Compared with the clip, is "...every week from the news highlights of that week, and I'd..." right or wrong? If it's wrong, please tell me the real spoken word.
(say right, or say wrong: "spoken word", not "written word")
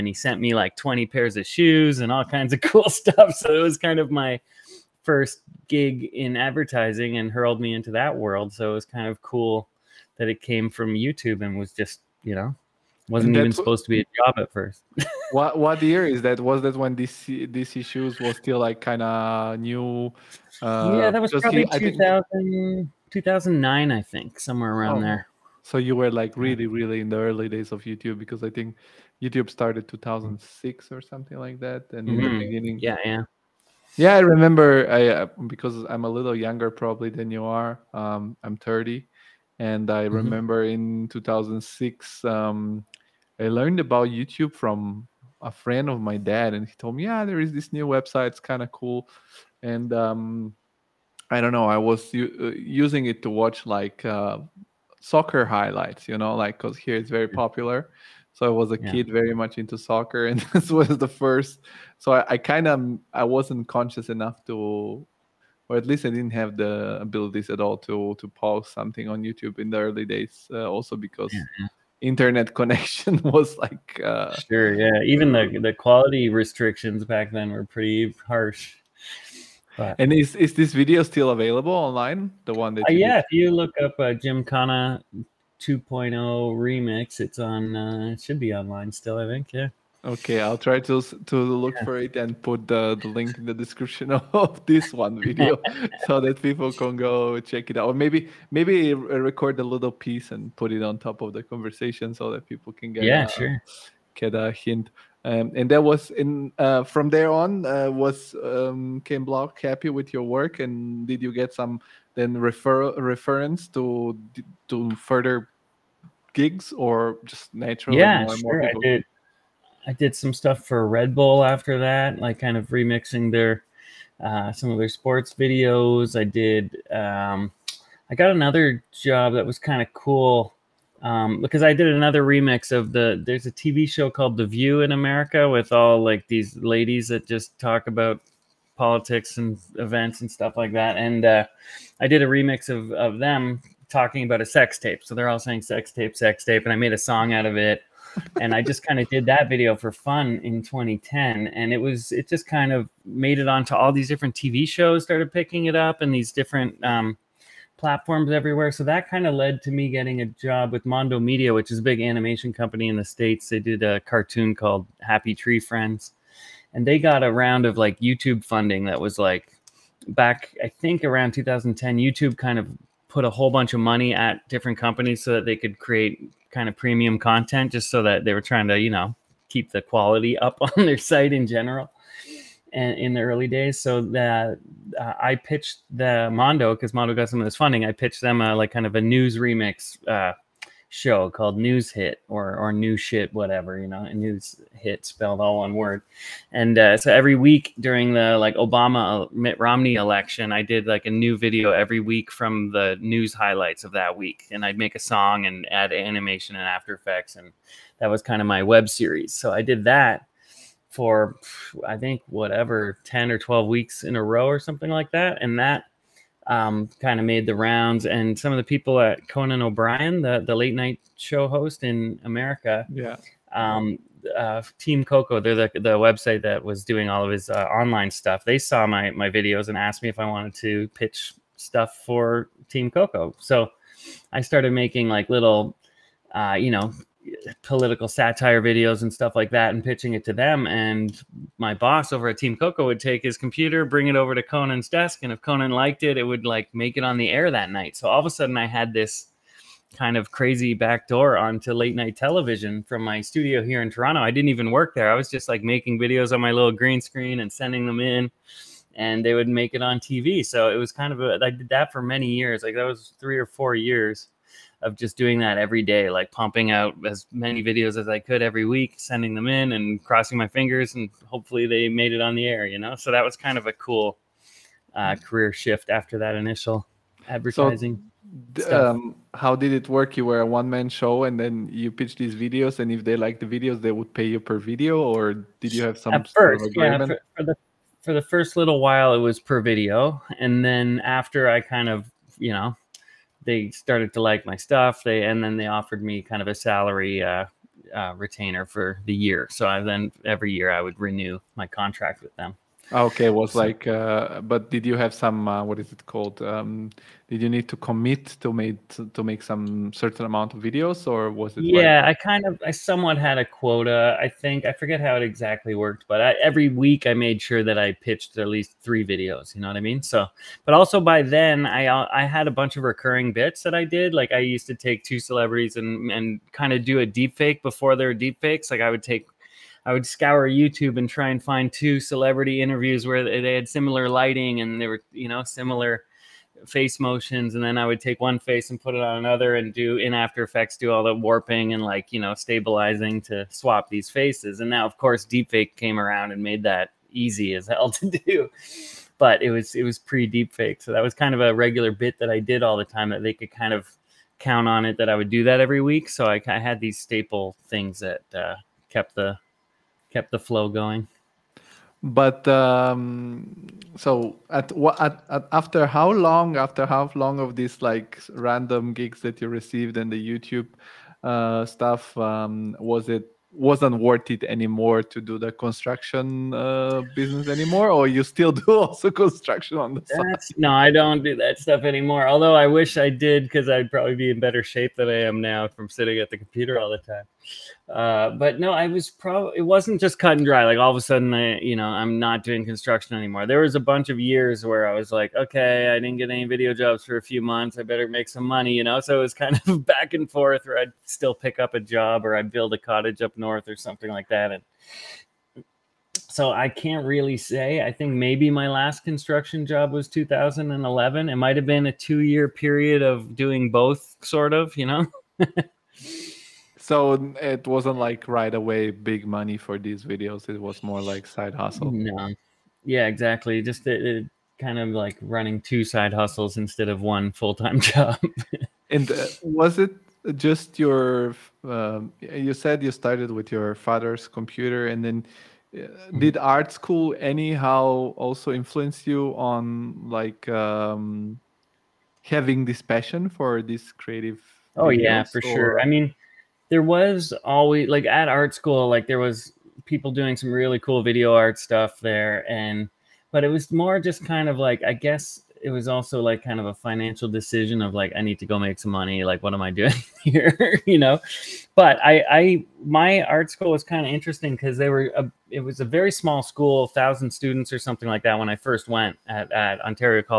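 right.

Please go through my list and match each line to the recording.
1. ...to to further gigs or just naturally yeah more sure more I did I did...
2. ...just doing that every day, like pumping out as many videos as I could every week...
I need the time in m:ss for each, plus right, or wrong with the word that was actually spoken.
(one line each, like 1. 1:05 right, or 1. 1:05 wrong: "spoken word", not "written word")
1. 1:53 right
2. 4:24 right.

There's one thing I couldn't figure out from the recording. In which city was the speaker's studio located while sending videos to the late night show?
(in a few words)
Toronto.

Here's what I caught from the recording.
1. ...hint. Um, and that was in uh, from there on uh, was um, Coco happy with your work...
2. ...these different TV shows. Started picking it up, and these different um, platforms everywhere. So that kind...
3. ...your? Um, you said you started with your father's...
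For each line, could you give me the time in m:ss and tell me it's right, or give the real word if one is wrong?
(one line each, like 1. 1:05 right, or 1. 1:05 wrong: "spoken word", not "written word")
1. 1:44 wrong: "Block", not "Coco"
2. 2:33 right
3. 7:10 right.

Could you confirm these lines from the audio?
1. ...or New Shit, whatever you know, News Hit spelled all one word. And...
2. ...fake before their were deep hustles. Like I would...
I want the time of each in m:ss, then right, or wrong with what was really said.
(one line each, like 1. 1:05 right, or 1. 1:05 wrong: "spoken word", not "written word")
1. 3:12 right
2. 5:27 wrong: "fakes", not "hustles".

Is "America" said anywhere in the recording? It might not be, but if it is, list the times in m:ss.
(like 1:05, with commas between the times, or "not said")
2:14, 3:42.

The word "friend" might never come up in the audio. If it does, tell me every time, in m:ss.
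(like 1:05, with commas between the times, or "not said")
0:45, 2:45.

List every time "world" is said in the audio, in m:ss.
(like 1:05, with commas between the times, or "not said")
0:08.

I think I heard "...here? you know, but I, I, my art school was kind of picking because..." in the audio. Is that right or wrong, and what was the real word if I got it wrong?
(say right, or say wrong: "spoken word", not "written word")
wrong: "interesting", not "picking".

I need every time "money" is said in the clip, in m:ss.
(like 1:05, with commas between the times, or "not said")
2:53, 6:38, 6:59, 7:38.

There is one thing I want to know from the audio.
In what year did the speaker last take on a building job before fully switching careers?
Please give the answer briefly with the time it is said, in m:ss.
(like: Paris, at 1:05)
2011, at 6:50.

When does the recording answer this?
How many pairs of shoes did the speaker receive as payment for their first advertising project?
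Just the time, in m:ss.
0:00.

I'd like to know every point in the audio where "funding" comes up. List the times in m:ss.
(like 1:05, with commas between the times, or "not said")
2:48, 3:07.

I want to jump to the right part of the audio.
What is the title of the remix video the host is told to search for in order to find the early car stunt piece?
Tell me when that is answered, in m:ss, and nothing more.
1:24.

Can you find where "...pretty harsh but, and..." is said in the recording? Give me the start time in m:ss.
1:17.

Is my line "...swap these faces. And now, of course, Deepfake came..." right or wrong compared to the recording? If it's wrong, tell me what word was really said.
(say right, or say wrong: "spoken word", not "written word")
right.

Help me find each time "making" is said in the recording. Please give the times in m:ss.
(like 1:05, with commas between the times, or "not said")
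3:54, 4:15.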